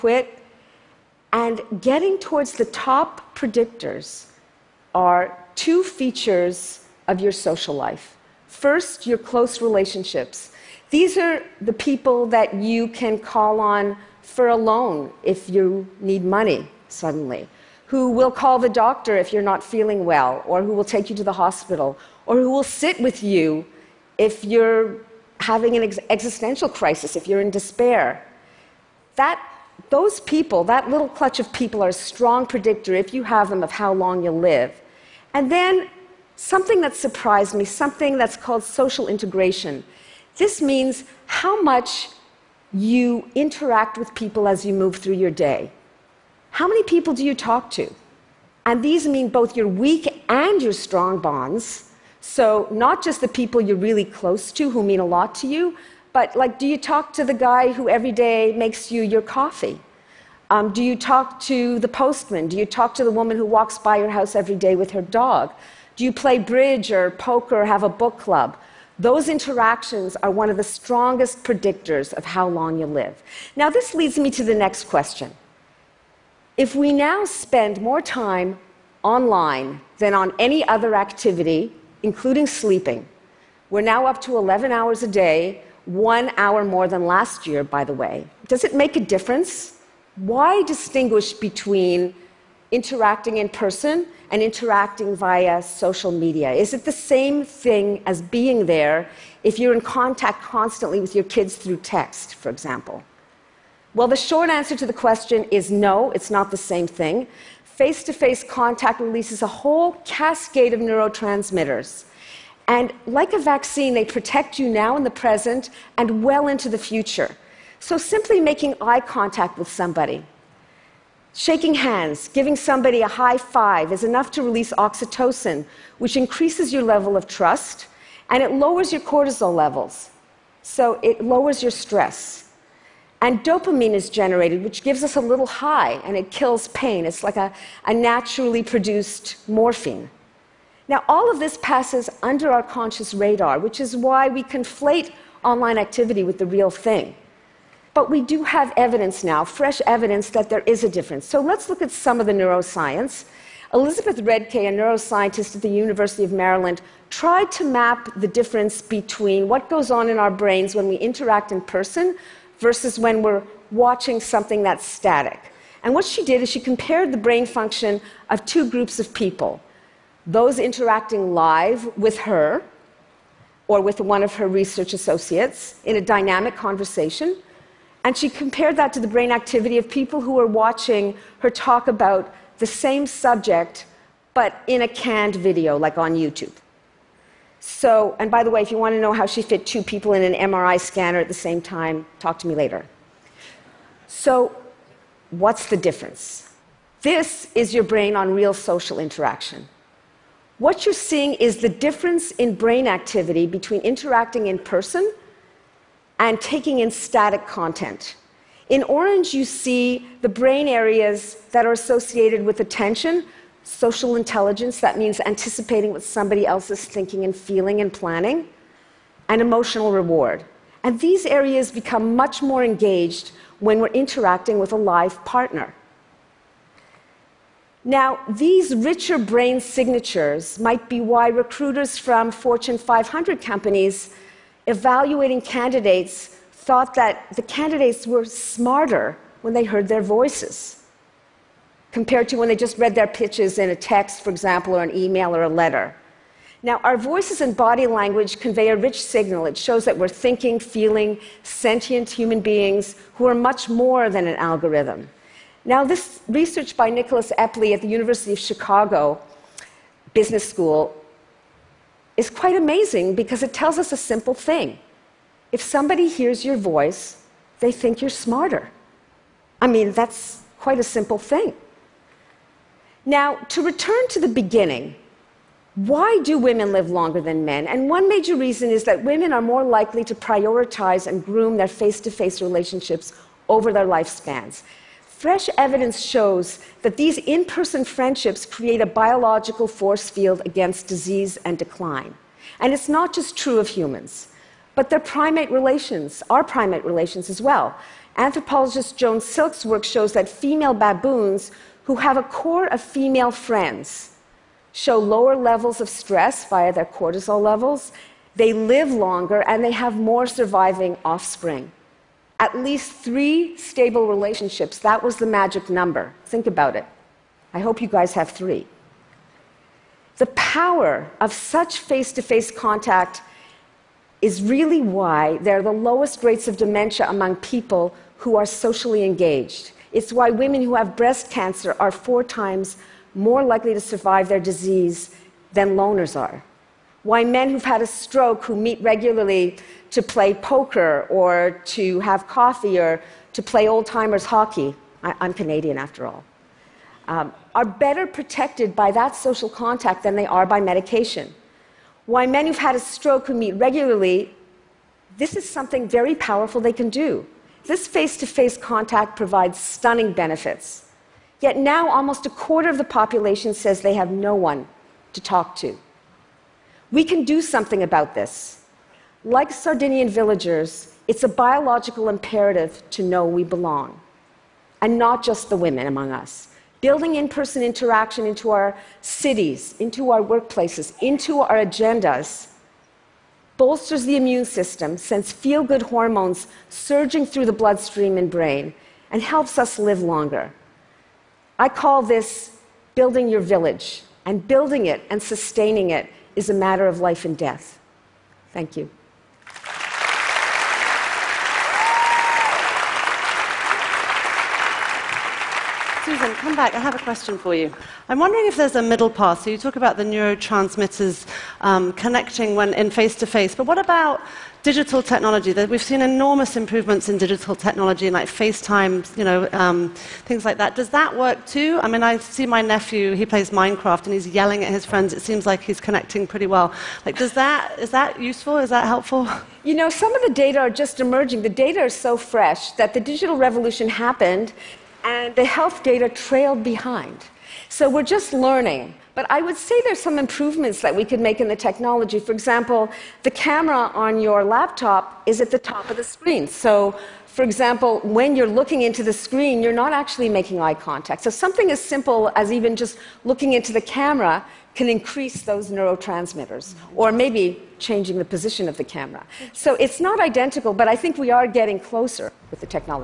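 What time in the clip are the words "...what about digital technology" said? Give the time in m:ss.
6:53.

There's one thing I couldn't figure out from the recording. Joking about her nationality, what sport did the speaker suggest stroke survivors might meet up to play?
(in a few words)
old timers hockey.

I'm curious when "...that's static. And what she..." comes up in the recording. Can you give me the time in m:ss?
2:44.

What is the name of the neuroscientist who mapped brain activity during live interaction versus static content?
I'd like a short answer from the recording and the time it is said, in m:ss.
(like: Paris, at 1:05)
Elizabeth Redcay, at 2:33.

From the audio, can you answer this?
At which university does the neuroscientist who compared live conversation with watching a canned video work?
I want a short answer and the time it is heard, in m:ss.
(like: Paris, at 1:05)
University of Maryland, at 2:35.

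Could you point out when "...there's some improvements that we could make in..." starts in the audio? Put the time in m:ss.
7:19.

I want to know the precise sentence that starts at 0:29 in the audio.
That those people, that little clutch of people, are a strong predictor, if you have them, of how long you'll live.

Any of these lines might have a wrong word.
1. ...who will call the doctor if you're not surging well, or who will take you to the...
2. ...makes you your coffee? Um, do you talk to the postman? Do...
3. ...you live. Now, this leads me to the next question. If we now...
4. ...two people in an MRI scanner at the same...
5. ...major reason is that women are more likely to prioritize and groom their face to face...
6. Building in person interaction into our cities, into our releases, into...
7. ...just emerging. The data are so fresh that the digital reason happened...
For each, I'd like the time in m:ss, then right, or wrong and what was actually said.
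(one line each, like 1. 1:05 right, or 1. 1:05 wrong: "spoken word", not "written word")
1. 0:17 wrong: "feeling", not "surging"
2. 0:58 right
3. 1:12 right
4. 3:09 right
5. 4:38 right
6. 6:16 wrong: "workplaces", not "releases"
7. 7:10 wrong: "revolution", not "reason".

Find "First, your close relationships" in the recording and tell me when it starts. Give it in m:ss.
0:08.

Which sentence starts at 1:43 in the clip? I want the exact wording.
Well, the short answer to the question is no, it's not the same thing.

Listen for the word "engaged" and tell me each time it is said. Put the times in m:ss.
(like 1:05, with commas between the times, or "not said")
3:42, 5:29.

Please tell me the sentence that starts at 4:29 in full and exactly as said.
I mean, that's quite a simple thing.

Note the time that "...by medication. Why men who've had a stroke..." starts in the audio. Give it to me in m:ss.
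5:50.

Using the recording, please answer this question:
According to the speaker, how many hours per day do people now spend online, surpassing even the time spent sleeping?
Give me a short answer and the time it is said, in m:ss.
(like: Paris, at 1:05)
11 hours, at 1:24.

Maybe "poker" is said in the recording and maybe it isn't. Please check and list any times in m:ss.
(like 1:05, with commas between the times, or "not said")
1:07, 5:40.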